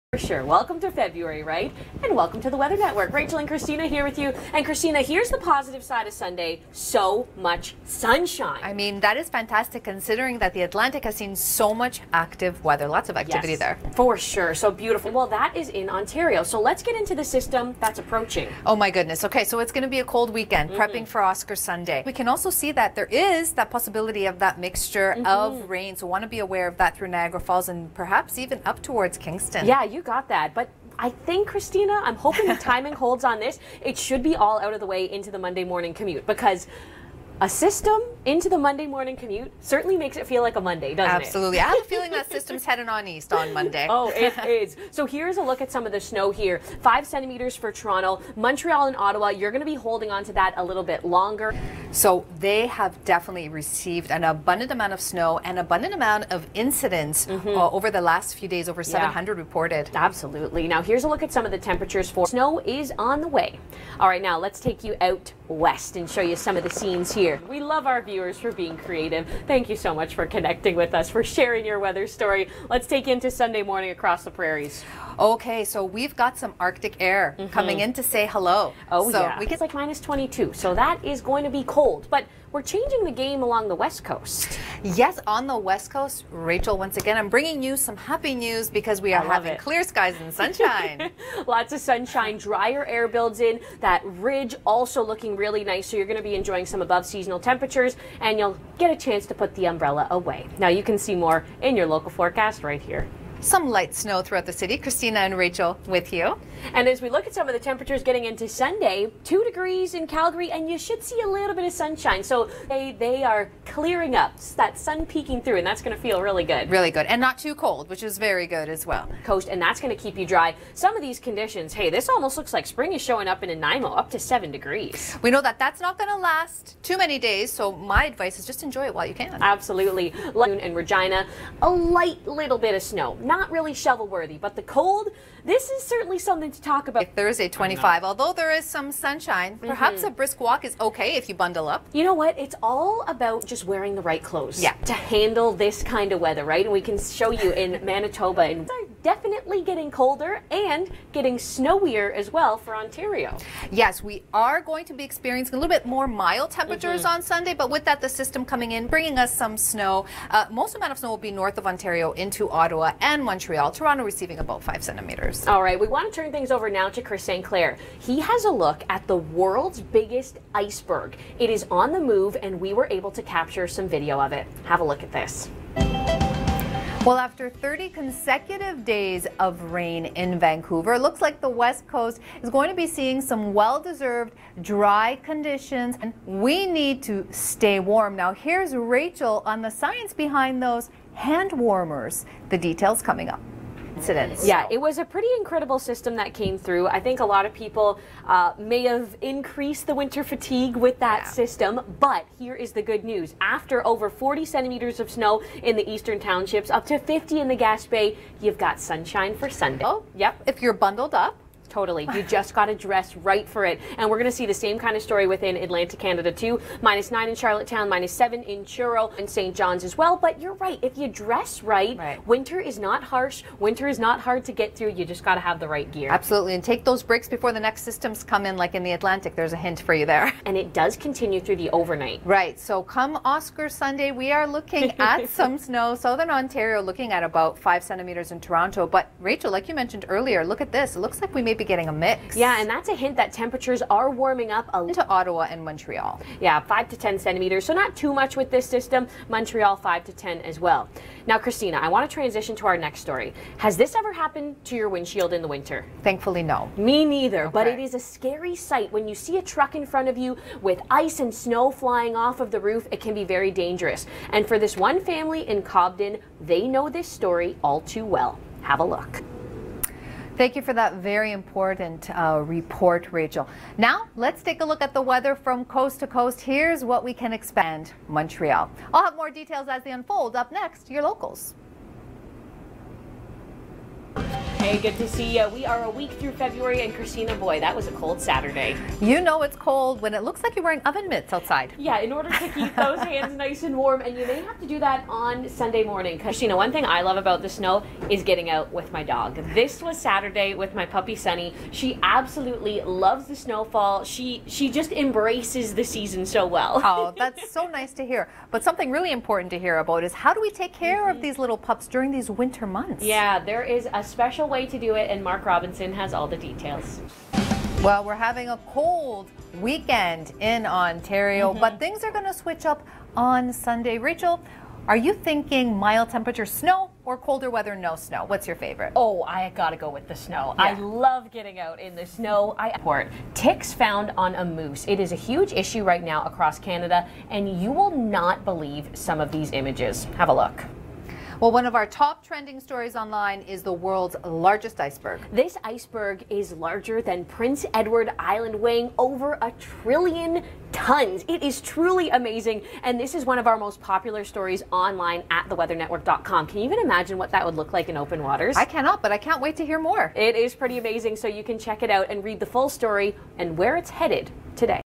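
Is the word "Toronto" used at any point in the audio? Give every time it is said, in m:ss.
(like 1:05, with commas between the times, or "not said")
0:47, 2:43, 3:58.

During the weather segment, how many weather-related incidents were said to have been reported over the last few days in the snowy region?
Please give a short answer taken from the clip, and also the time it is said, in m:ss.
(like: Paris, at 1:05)
over 700, at 0:58.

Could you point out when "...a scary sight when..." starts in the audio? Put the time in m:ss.
4:17.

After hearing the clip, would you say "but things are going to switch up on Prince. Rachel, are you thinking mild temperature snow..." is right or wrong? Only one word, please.
wrong.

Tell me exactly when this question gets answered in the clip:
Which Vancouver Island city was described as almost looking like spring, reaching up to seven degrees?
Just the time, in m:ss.
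2:03.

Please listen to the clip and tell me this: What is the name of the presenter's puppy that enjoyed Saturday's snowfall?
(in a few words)
Sunny.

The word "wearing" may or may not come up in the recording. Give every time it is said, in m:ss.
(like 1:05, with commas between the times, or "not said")
2:23, 4:50.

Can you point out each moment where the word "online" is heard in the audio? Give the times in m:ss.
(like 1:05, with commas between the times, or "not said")
5:42, 5:54.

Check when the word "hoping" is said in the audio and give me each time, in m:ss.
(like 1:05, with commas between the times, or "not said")
0:32.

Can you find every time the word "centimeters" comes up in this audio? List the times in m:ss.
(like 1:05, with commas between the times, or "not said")
0:47, 2:44, 3:24, 3:57, 4:07.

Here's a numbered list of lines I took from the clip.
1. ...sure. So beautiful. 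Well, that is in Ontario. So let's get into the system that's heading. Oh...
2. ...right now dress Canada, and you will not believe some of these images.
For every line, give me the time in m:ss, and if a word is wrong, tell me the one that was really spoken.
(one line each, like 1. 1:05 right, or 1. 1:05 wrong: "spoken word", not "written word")
1. 0:14 wrong: "approaching", not "heading"
2. 5:35 wrong: "across", not "dress".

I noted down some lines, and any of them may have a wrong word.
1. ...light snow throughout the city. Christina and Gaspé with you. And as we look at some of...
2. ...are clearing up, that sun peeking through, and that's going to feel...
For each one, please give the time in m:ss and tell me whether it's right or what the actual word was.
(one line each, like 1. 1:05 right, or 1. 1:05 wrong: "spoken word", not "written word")
1. 1:43 wrong: "Rachel", not "Gaspé"
2. 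1:53 right.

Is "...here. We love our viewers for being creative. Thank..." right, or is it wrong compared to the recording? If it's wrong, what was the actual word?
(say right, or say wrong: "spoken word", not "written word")
right.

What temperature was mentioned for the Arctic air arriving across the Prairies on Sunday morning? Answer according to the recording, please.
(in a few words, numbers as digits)
-22.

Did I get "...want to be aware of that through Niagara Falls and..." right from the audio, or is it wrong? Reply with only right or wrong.
right.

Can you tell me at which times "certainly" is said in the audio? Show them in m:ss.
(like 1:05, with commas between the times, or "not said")
0:39, 2:15.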